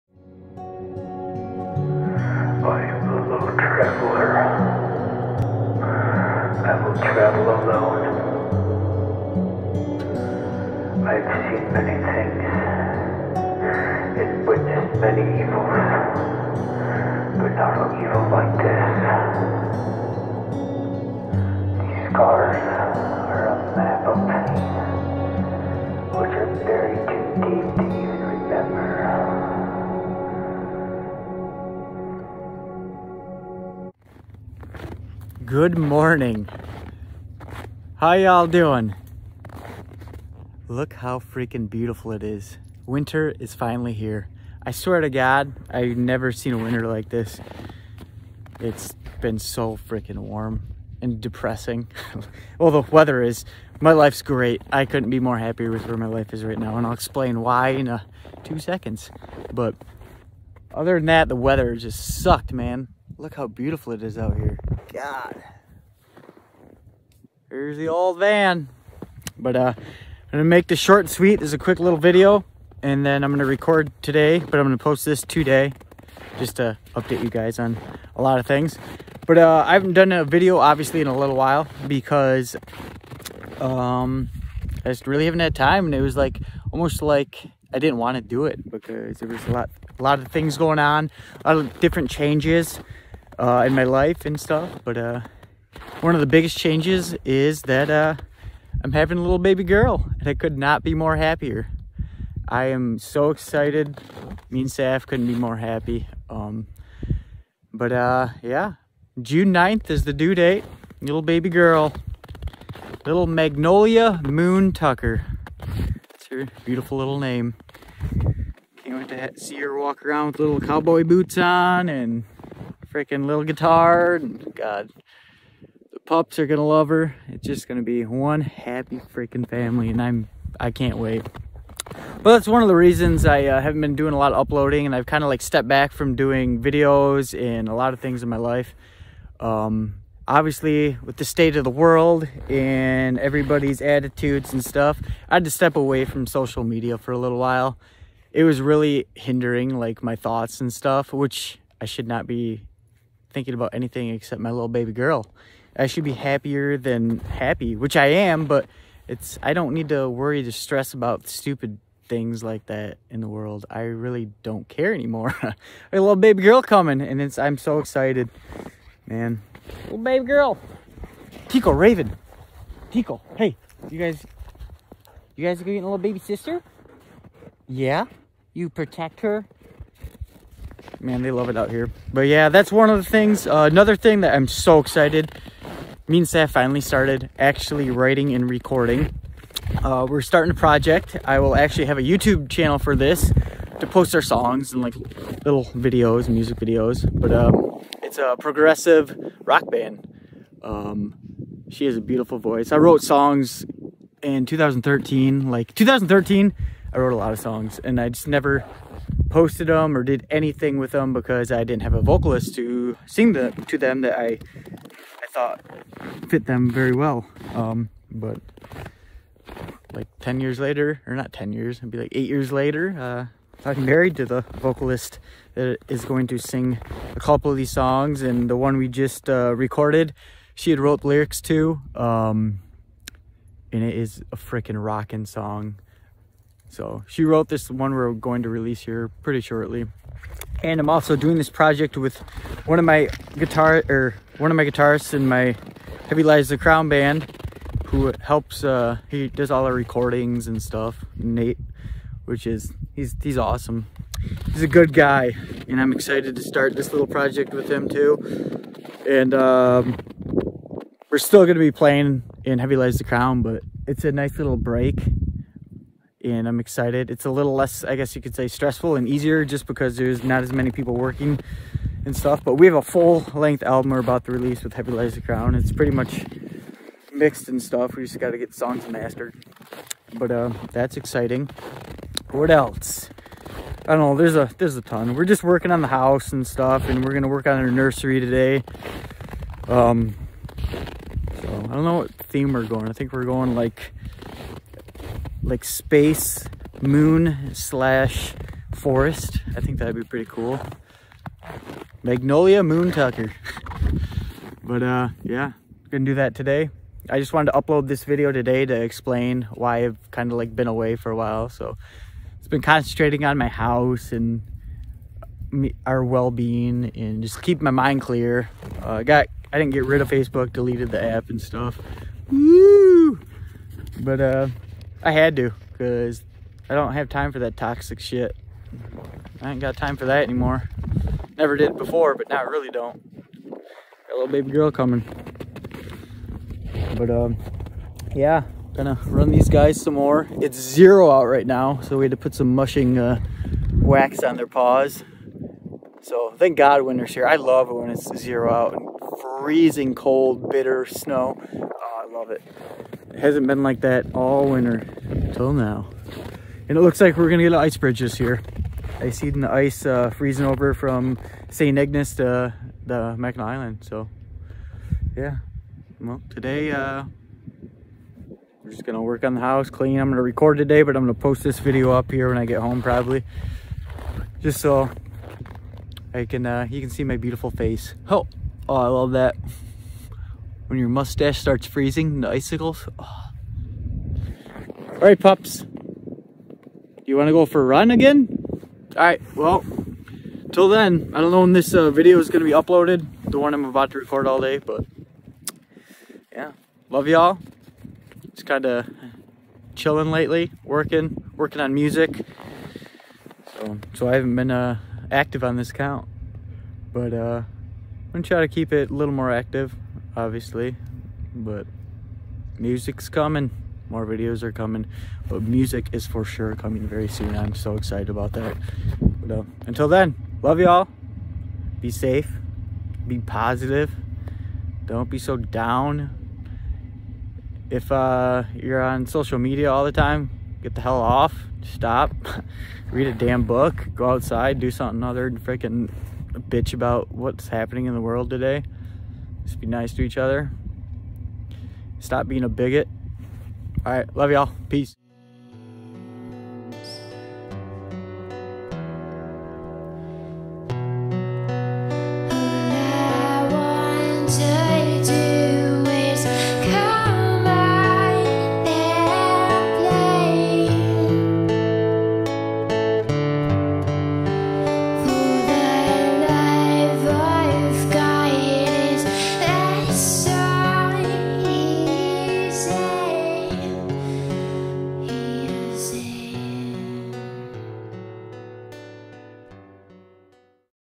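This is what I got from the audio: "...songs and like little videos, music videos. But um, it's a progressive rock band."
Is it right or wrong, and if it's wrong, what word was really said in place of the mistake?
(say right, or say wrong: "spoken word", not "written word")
right.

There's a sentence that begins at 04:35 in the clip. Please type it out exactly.
It's pretty much mixed and stuff.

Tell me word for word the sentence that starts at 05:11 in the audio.
So it's been concentrating on my house and me, our well-being and just keep my mind clear.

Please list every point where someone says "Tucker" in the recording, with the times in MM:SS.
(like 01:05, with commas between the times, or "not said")
01:54, 05:02.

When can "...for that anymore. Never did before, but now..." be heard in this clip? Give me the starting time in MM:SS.
05:29.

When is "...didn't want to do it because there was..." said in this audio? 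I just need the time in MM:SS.
01:27.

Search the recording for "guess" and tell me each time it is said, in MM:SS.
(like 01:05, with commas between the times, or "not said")
04:27.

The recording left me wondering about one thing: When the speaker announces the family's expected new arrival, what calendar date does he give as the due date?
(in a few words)
June 9.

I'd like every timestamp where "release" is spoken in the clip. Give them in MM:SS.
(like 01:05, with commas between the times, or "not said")
03:58, 04:34.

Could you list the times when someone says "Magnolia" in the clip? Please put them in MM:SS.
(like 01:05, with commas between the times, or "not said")
01:53, 05:02.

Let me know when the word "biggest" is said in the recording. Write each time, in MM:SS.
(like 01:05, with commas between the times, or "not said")
01:36.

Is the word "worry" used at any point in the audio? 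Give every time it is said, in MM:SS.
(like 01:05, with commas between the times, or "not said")
02:40.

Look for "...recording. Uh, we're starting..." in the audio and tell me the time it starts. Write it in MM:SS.
03:08.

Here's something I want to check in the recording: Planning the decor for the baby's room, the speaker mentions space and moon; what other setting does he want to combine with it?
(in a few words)
Forest.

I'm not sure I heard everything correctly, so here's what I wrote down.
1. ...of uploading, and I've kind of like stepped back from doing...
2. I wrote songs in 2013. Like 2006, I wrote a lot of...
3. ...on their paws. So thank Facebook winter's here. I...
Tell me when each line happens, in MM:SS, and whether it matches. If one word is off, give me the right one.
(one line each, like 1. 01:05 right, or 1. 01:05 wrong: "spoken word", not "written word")
1. 02:14 right
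2. 03:22 wrong: "2013", not "2006"
3. 05:44 wrong: "God", not "Facebook".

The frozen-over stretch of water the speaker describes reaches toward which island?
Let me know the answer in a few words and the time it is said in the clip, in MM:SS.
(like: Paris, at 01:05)
Mackinac Island, at 06:03.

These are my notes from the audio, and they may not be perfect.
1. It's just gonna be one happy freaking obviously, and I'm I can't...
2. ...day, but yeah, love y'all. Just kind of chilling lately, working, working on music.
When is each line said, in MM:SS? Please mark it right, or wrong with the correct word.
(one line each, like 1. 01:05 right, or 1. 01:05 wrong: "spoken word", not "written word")
1. 02:07 wrong: "family", not "obviously"
2. 06:34 right.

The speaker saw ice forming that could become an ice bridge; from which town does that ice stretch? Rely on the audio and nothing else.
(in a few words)
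St. Ignace.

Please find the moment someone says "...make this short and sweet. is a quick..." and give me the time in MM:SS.
01:10.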